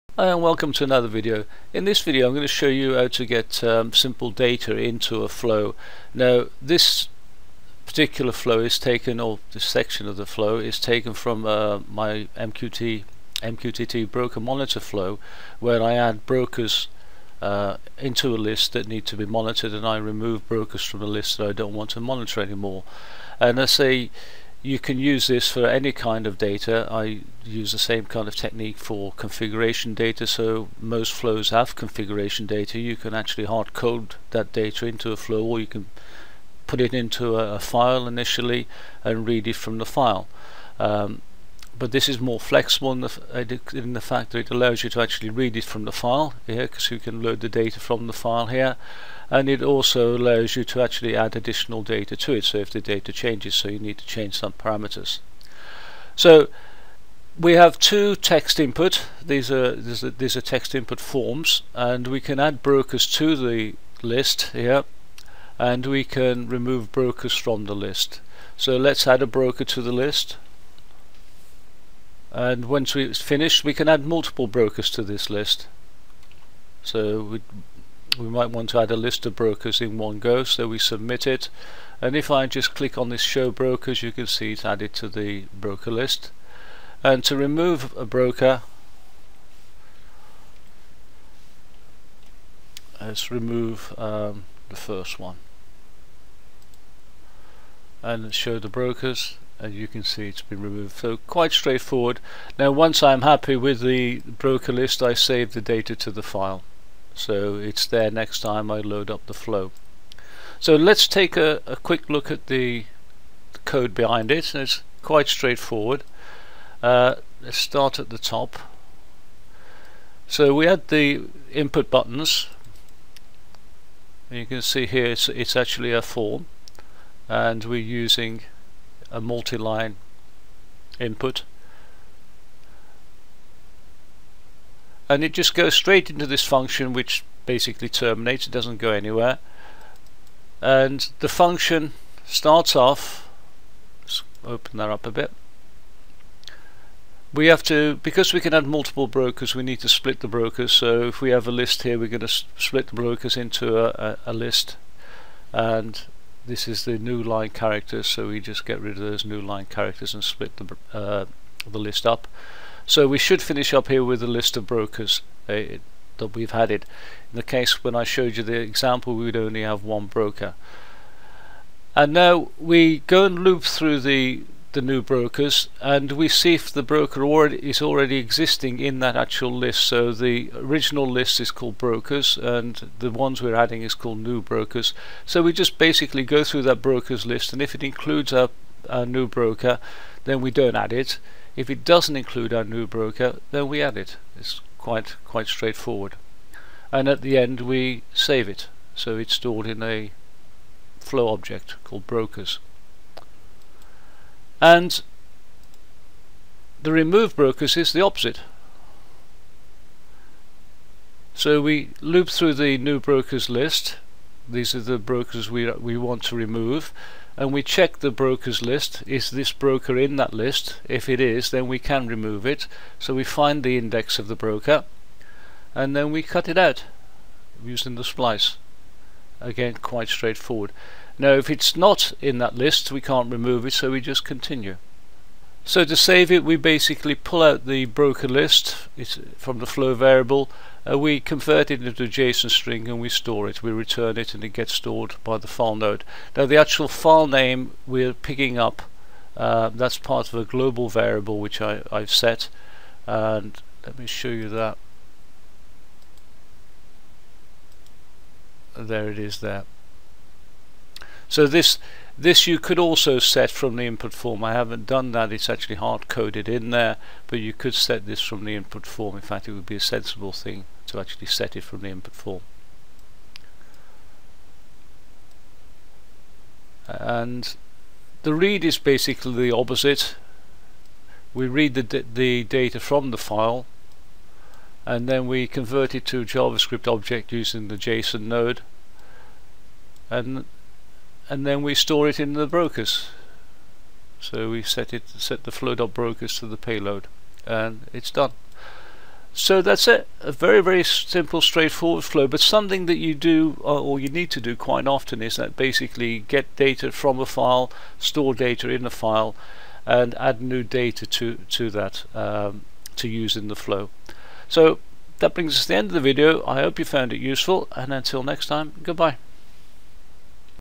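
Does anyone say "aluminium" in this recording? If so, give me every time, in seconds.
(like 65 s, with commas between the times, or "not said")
not said.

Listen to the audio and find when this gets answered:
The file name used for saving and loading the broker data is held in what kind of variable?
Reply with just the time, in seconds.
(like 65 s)
250 s.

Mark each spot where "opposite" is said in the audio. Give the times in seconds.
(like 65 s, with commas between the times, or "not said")
208 s, 279 s.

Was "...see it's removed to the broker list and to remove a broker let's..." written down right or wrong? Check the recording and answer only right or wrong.
wrong.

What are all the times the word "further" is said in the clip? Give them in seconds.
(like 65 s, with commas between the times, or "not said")
not said.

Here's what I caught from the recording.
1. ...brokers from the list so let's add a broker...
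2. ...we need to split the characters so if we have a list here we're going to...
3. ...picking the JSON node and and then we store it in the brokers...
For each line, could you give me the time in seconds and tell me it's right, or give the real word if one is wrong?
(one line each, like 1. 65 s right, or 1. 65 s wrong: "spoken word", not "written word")
1. 66 s right
2. 149 s wrong: "brokers", not "characters"
3. 287 s wrong: "using", not "picking".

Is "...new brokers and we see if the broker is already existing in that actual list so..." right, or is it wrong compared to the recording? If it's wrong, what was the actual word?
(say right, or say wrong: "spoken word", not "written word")
right.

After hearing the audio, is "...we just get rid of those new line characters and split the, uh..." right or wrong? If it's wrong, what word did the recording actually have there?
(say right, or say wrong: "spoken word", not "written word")
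right.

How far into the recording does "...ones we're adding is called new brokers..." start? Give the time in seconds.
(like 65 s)
183 s.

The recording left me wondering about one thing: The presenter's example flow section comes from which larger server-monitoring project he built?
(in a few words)
MQTT broker monitor flow.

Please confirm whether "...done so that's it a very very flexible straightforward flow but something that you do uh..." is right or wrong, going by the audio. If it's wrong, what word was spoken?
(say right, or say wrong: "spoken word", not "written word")
wrong: "simple", not "flexible".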